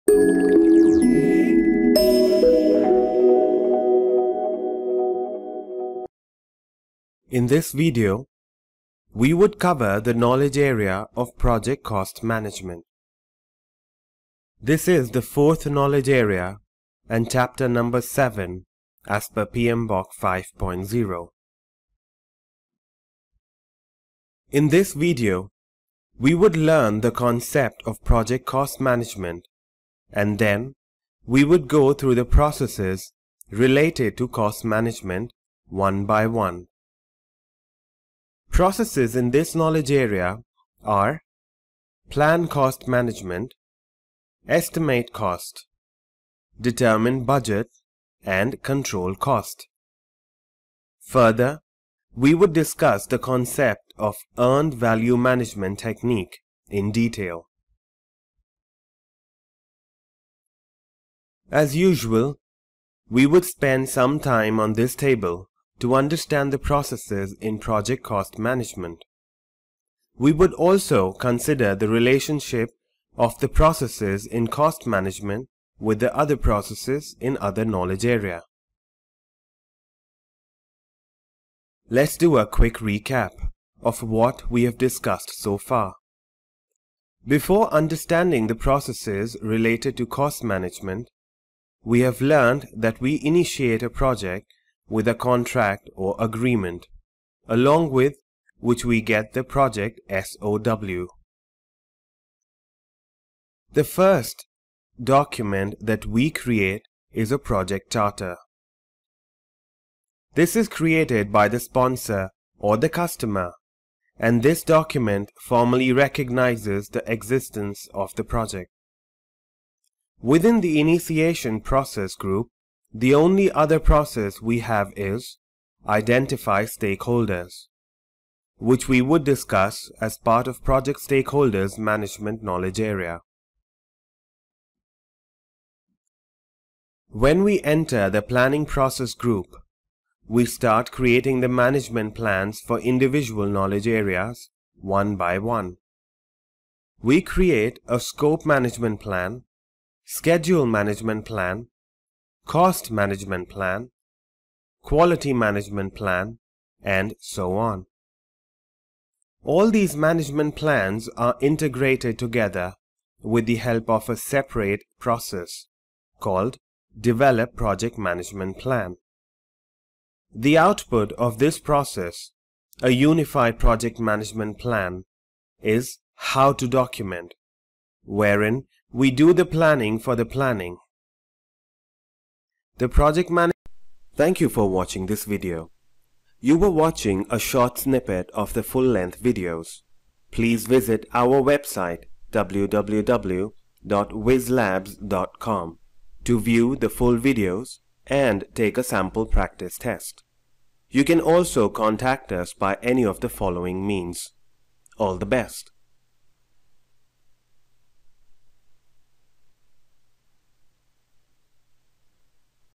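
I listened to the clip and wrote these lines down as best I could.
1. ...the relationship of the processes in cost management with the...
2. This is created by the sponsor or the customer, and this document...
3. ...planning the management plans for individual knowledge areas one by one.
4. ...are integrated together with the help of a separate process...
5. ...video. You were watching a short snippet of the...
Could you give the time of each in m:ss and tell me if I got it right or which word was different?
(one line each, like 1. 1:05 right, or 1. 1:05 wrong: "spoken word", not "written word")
1. 1:11 right
2. 1:50 right
3. 2:20 wrong: "creating", not "planning"
4. 2:41 right
5. 3:05 right.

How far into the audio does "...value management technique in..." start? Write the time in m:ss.
0:54.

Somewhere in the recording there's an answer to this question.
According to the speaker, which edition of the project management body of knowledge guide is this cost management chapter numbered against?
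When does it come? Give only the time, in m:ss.
0:19.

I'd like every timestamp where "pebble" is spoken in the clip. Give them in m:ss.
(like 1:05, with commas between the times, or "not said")
not said.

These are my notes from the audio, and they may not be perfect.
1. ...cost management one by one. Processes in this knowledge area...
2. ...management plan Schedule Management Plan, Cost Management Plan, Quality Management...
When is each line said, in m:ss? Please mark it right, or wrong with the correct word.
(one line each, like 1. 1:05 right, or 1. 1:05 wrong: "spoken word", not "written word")
1. 0:34 right
2. 2:28 right.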